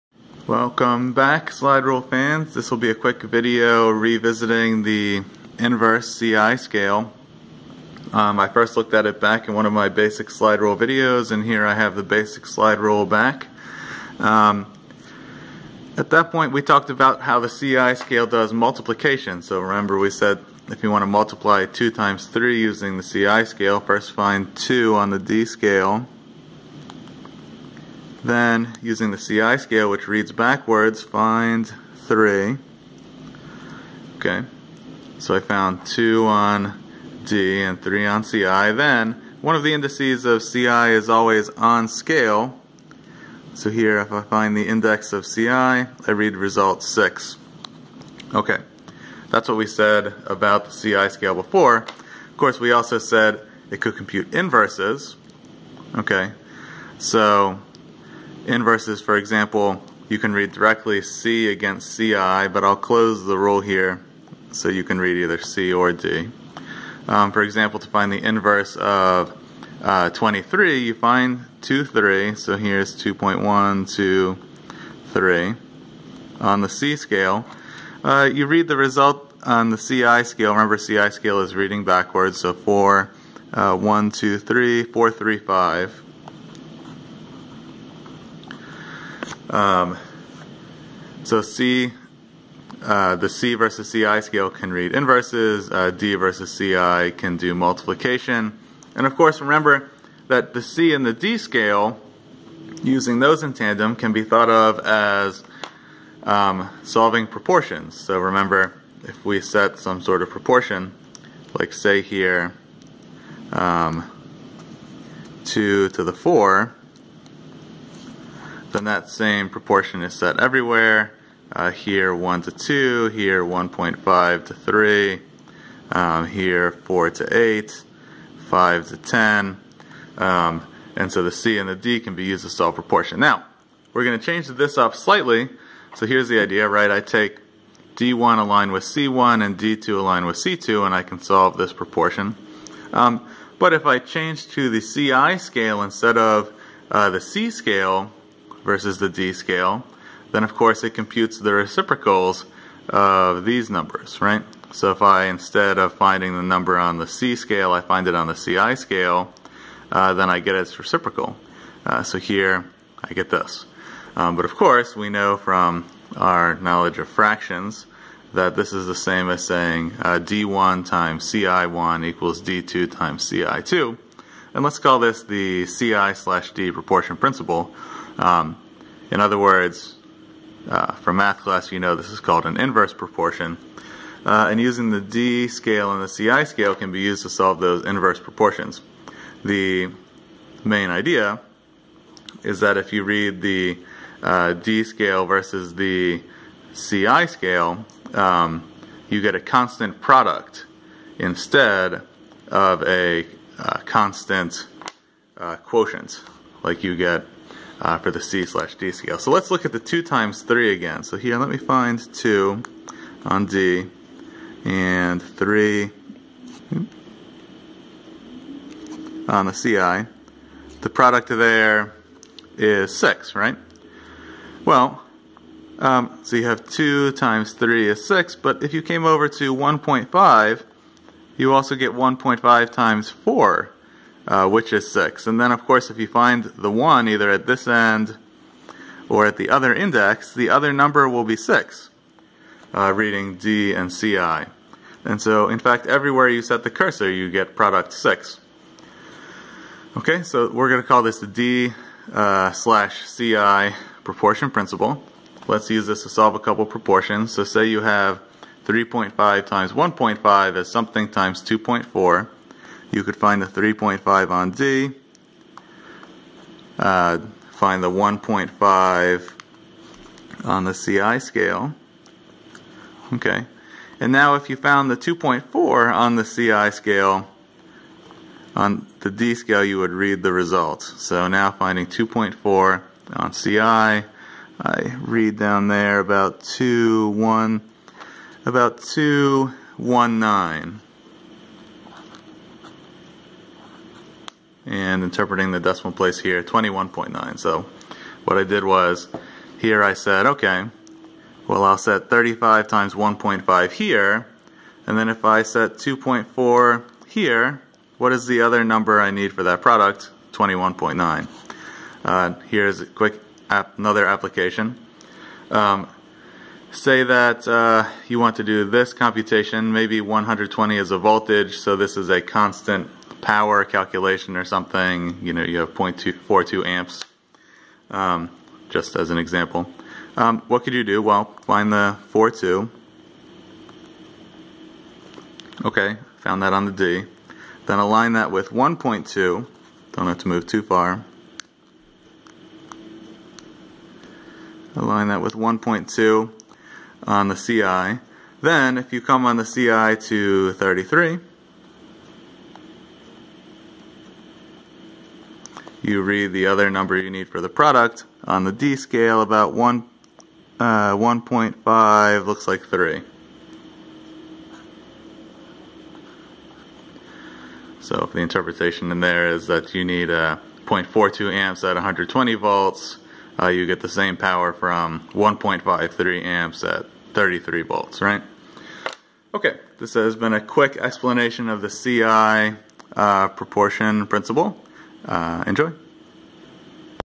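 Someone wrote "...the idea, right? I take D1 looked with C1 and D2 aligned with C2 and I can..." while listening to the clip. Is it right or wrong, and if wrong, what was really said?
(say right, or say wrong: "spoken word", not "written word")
wrong: "aligned", not "looked".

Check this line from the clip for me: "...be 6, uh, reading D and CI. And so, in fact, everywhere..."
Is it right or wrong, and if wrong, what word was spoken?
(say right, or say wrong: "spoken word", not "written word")
right.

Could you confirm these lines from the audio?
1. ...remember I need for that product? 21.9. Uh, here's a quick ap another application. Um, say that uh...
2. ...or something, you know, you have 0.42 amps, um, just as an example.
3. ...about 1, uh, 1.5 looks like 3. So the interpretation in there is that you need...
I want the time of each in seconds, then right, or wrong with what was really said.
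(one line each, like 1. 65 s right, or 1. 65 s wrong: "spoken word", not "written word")
1. 308 s wrong: "number", not "remember"
2. 324 s right
3. 359 s right.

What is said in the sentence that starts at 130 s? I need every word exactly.
Um, and so the C and the D can be used to solve proportion.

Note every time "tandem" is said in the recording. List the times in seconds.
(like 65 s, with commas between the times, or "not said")
103 s.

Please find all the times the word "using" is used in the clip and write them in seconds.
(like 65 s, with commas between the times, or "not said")
22 s, 28 s, 102 s, 184 s.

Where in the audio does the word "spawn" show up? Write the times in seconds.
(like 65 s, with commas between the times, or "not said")
not said.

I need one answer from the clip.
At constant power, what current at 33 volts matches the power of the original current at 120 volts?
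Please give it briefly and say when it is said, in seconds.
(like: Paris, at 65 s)
1.53, at 375 s.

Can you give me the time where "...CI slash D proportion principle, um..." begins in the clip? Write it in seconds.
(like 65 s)
175 s.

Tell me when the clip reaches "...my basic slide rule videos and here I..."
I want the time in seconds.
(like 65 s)
9 s.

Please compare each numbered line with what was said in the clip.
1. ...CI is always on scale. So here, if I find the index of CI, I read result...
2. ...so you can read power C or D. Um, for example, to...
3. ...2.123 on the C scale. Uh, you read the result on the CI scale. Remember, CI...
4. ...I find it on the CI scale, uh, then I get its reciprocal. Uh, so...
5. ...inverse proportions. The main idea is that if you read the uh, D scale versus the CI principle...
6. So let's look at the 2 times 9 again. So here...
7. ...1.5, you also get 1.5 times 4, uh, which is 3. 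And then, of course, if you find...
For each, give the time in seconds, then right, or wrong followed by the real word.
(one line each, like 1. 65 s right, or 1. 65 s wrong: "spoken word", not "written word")
1. 40 s right
2. 64 s wrong: "either", not "power"
3. 73 s right
4. 157 s right
5. 187 s wrong: "scale", not "principle"
6. 209 s wrong: "3", not "9"
7. 229 s wrong: "6", not "3".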